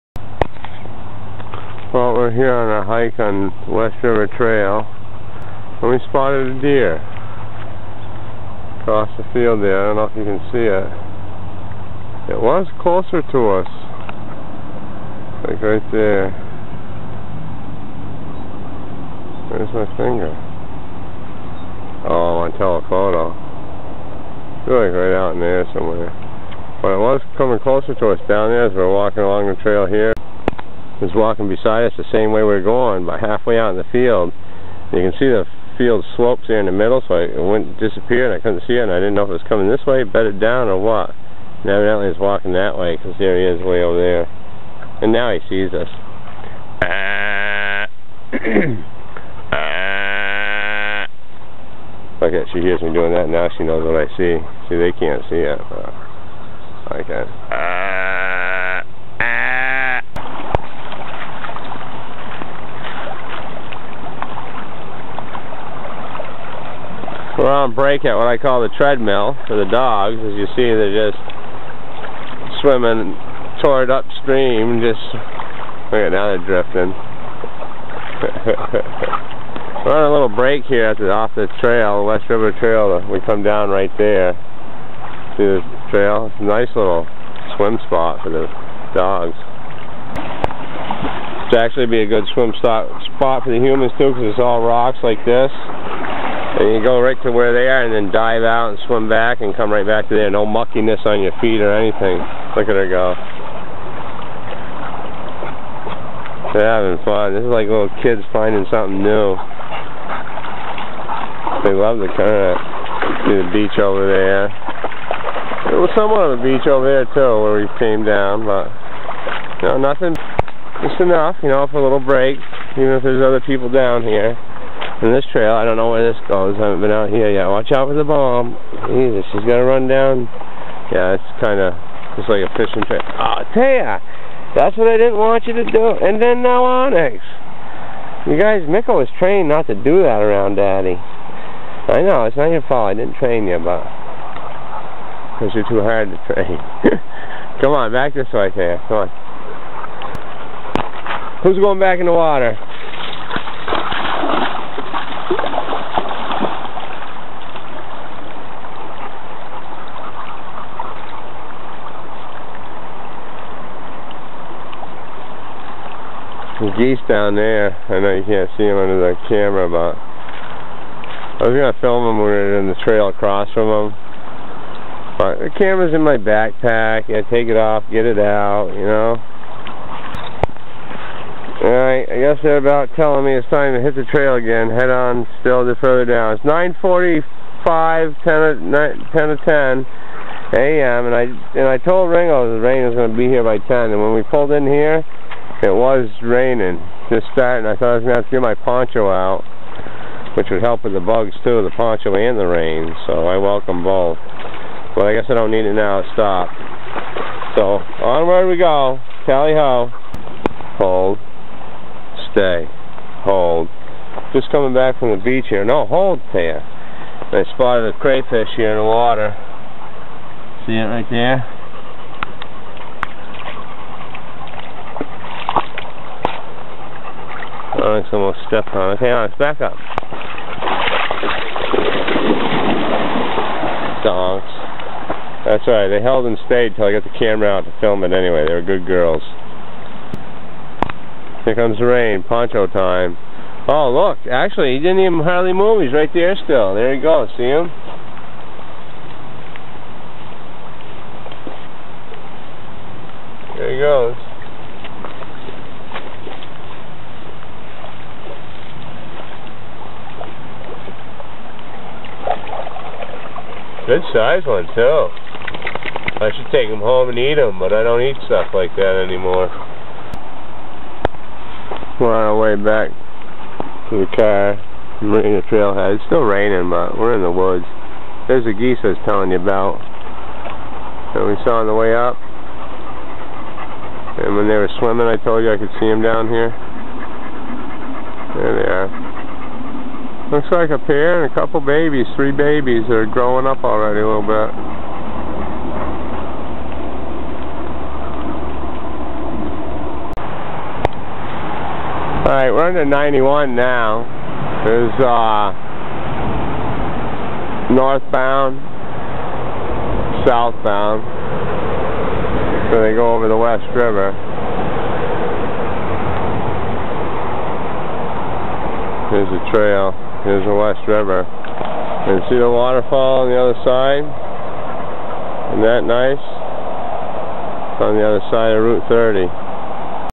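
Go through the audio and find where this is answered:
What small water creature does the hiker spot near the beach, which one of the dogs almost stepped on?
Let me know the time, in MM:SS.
03:38.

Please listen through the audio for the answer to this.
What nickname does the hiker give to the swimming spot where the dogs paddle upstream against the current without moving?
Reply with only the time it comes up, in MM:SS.
01:08.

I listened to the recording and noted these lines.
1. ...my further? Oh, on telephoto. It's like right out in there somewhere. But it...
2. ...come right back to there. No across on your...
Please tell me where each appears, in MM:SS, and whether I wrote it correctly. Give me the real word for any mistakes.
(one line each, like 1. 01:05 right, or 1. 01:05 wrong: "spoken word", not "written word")
1. 00:19 wrong: "finger", not "further"
2. 01:39 wrong: "muckiness", not "across".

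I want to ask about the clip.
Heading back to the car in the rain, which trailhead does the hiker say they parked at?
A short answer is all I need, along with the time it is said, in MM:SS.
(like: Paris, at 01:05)
Marina Trailhead, at 04:35.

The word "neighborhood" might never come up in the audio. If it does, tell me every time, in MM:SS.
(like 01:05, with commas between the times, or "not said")
not said.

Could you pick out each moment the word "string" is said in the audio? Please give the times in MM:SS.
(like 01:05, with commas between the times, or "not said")
not said.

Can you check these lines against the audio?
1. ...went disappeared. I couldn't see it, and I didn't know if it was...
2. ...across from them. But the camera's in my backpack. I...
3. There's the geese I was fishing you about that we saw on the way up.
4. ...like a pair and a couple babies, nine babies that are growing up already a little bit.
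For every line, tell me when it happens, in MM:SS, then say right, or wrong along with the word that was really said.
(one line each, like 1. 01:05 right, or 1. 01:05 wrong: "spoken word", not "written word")
1. 00:37 right
2. 02:53 right
3. 04:38 wrong: "telling", not "fishing"
4. 04:50 wrong: "three", not "nine".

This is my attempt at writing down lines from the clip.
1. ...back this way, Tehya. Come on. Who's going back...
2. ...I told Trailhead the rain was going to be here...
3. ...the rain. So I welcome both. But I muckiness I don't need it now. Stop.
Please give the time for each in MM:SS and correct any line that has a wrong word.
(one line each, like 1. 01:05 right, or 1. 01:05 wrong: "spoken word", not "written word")
1. 02:27 right
2. 03:11 wrong: "Ringo", not "Trailhead"
3. 03:22 wrong: "guess", not "muckiness".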